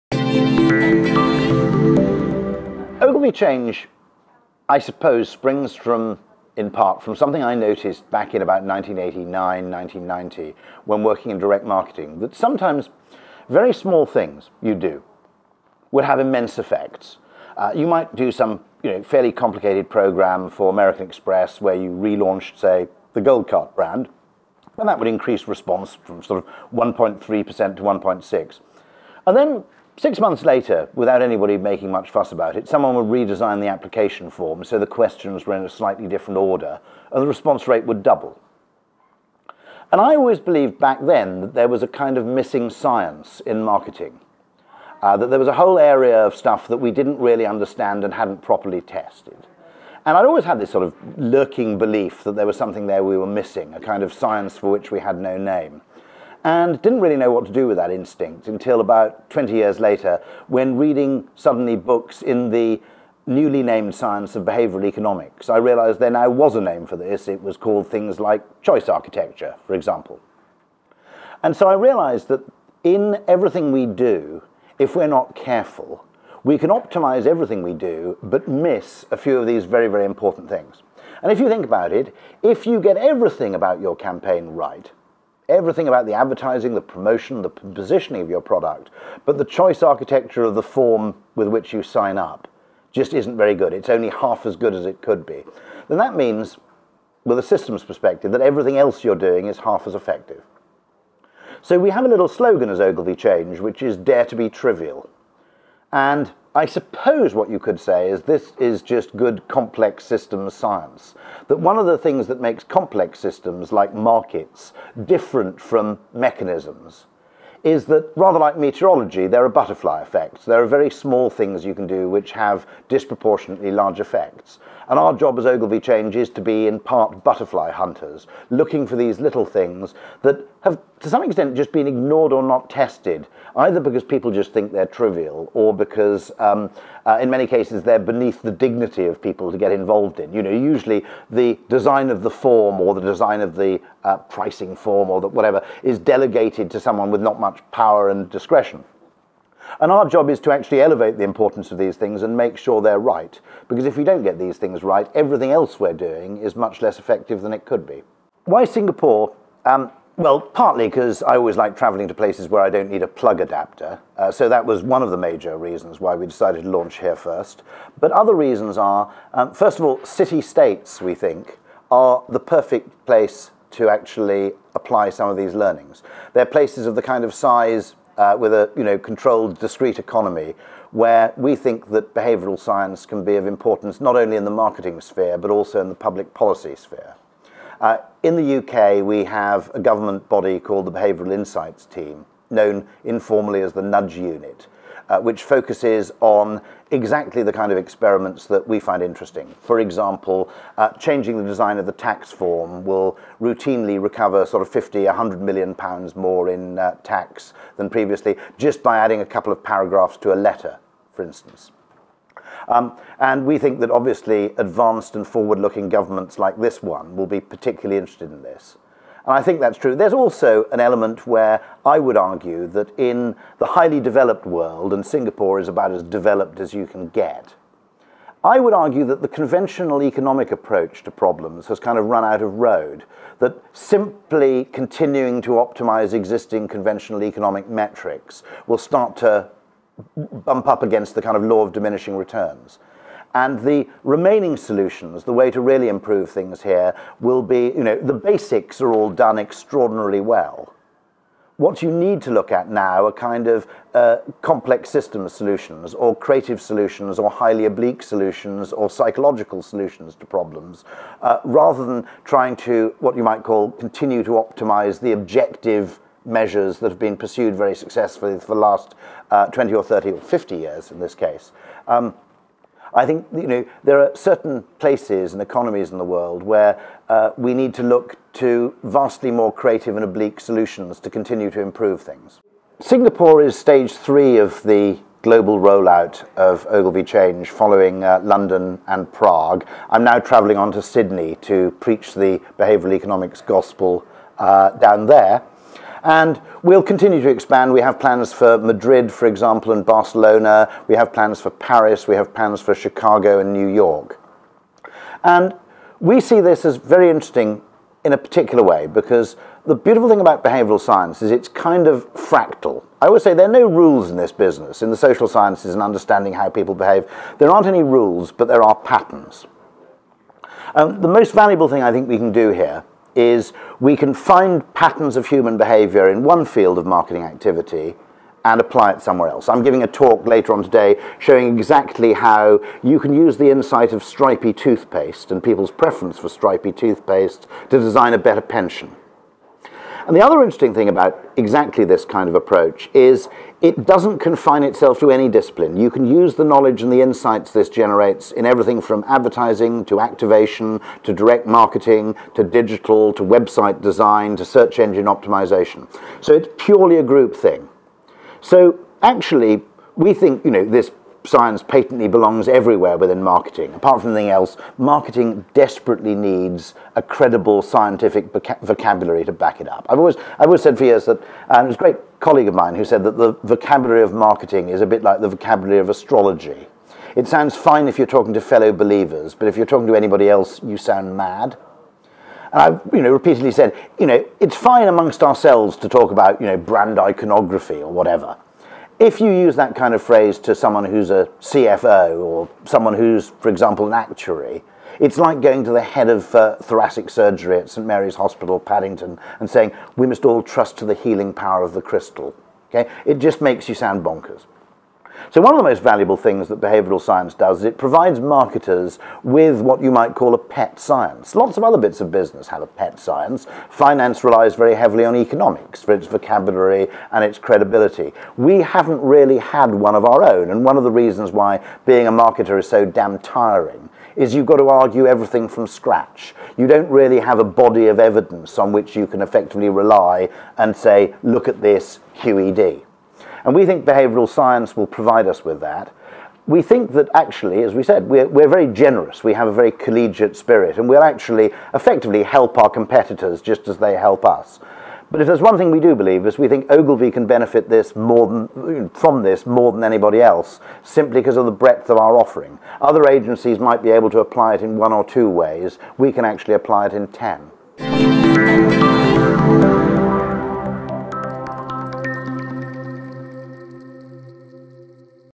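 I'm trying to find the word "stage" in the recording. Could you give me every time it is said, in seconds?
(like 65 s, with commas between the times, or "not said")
283 s.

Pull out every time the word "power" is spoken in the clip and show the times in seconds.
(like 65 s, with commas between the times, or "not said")
147 s, 401 s.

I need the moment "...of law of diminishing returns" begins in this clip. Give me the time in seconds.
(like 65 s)
241 s.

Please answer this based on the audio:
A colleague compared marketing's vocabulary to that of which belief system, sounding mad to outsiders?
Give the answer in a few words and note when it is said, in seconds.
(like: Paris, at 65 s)
astrology, at 375 s.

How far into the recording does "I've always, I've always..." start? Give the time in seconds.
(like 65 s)
369 s.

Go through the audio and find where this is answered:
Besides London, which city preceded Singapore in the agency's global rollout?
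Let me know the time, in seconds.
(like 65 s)
289 s.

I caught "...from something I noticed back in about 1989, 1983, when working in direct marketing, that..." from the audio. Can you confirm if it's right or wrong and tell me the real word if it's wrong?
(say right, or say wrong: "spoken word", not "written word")
wrong: "1990", not "1983".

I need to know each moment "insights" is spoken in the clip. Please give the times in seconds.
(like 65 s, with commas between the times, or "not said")
191 s, 333 s, 347 s.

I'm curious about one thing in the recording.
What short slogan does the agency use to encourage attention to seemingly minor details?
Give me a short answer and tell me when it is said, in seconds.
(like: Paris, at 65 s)
dare to be trivial, at 103 s.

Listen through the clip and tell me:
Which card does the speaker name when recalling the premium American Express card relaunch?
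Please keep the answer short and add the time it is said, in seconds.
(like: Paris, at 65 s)
Gold Card, at 23 s.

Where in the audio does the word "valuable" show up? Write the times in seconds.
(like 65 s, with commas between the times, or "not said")
321 s, 405 s.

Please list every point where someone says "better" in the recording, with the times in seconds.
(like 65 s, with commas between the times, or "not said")
338 s.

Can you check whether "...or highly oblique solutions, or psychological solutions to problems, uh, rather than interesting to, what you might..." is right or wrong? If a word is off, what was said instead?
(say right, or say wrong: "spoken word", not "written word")
wrong: "trying", not "interesting".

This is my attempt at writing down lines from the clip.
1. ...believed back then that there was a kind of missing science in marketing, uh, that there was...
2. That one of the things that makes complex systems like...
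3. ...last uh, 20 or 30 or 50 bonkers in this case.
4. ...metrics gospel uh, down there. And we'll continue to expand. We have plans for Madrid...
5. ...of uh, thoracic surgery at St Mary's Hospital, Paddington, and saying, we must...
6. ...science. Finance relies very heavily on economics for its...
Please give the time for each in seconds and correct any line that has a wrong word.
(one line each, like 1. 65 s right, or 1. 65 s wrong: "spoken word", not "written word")
1. 40 s right
2. 111 s right
3. 268 s wrong: "years", not "bonkers"
4. 292 s wrong: "economics", not "metrics"
5. 396 s right
6. 412 s right.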